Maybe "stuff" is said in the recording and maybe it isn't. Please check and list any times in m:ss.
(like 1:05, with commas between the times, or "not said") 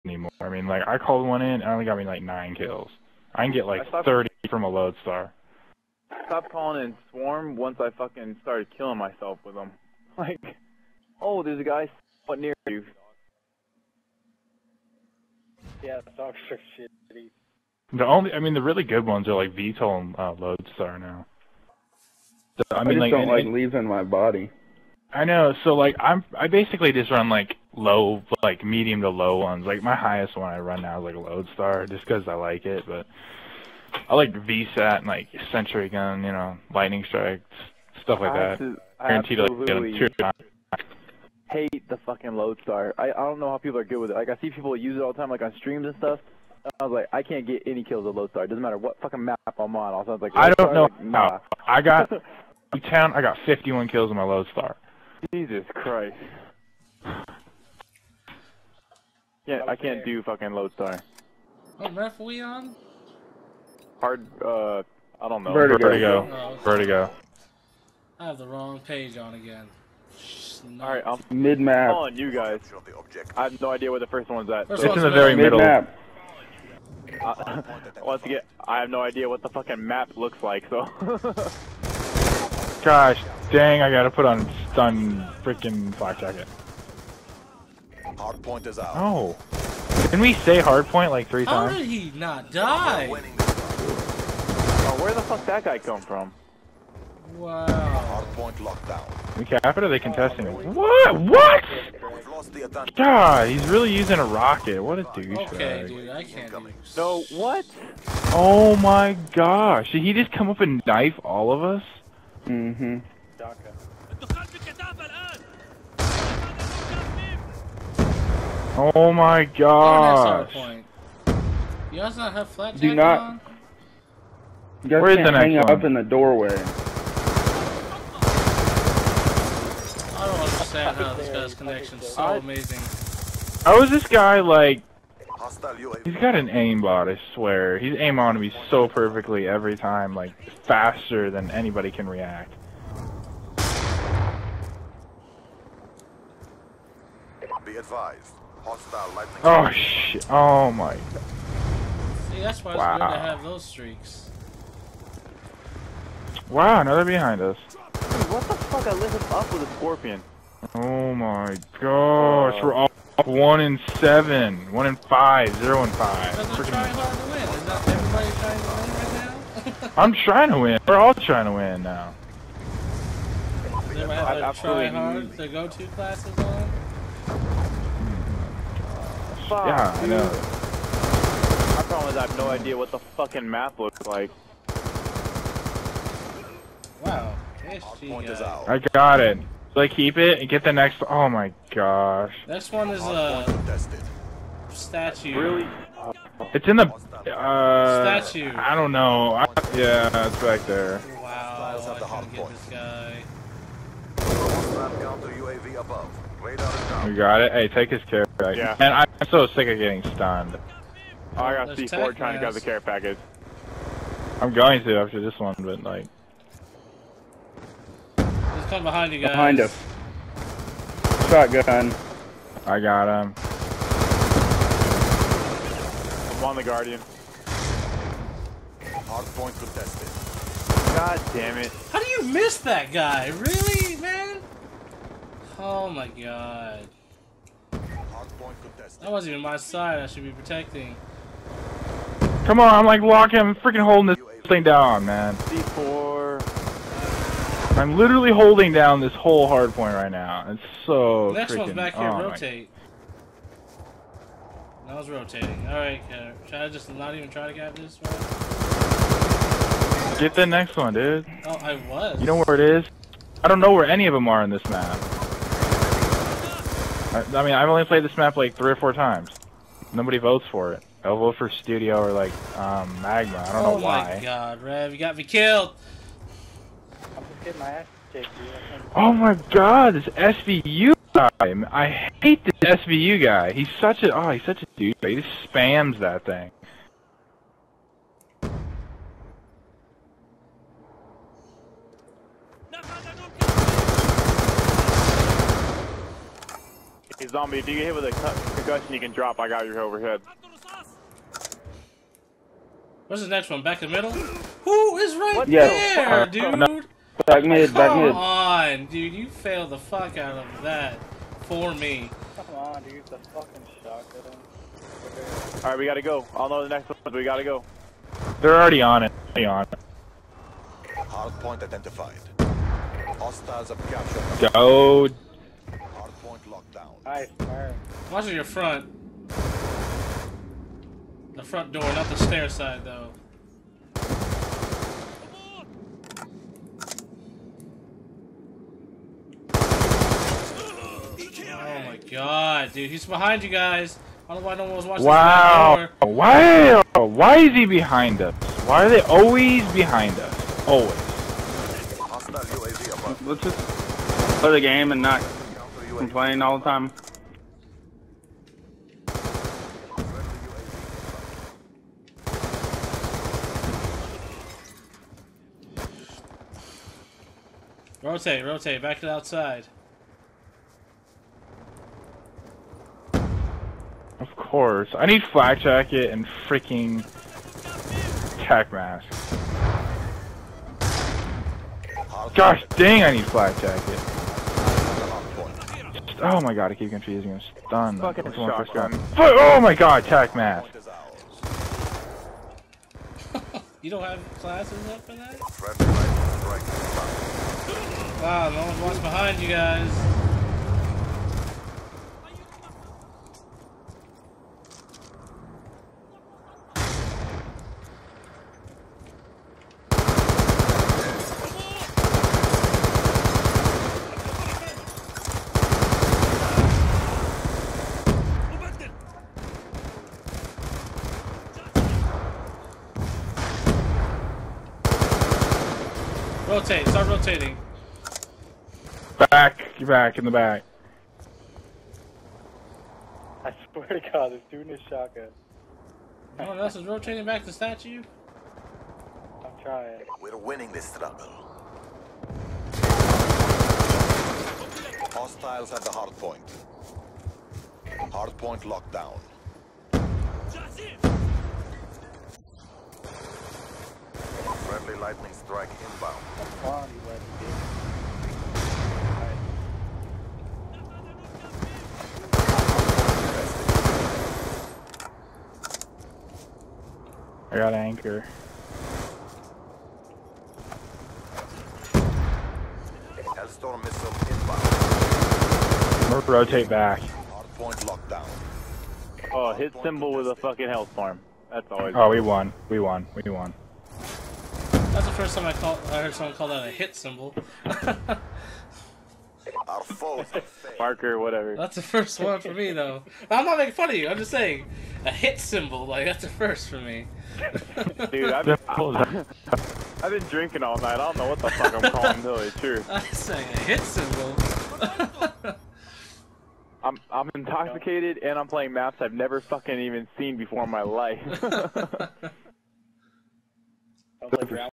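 0:38, 0:45.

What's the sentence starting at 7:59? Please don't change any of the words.
Oh, hit symbol with a fucking health farm.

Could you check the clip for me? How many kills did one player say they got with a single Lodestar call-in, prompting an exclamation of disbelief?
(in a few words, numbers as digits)
51.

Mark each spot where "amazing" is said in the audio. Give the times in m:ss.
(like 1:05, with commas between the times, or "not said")
2:12.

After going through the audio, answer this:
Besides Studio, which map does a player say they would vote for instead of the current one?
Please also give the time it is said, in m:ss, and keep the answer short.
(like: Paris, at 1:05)
Magma, at 4:33.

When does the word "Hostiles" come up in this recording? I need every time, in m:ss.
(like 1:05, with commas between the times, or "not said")
5:23, 7:25.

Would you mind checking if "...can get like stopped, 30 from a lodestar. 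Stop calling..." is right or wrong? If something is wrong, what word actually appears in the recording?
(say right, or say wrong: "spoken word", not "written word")
right.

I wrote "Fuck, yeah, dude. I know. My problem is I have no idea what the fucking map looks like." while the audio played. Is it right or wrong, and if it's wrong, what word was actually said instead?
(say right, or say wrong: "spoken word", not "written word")
right.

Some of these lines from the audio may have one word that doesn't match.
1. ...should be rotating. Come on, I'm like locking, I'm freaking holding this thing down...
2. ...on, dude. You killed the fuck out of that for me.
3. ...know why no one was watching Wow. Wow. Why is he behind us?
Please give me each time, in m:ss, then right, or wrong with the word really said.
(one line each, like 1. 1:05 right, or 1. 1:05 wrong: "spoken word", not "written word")
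1. 4:00 wrong: "protecting", not "rotating"
2. 5:08 wrong: "failed", not "killed"
3. 5:44 right.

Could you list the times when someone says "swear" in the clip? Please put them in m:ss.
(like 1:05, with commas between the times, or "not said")
2:17, 7:13.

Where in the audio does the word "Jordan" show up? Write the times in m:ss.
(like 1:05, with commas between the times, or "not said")
not said.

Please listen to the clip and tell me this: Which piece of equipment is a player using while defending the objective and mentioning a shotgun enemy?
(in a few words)
Guardian.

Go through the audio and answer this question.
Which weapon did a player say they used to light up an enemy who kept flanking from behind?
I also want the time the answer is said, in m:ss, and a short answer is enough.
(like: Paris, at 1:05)
Scorpion, at 2:39.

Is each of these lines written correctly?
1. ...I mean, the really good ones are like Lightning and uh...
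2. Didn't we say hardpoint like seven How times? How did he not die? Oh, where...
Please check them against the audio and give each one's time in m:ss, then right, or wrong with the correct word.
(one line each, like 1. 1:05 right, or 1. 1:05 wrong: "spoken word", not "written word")
1. 0:18 wrong: "VTOL", not "Lightning"
2. 1:30 wrong: "three", not "seven".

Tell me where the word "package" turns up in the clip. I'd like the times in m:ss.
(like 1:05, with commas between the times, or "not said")
3:28, 3:32.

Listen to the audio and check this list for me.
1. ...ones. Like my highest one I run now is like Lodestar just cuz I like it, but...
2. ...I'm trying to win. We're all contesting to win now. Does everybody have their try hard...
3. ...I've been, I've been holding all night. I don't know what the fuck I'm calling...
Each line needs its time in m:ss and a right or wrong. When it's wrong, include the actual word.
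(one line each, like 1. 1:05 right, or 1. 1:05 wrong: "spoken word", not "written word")
1. 0:29 right
2. 2:50 wrong: "trying", not "contesting"
3. 8:18 wrong: "drinking", not "holding".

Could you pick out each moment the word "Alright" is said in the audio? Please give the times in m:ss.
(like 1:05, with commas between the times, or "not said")
1:10, 4:15, 5:15.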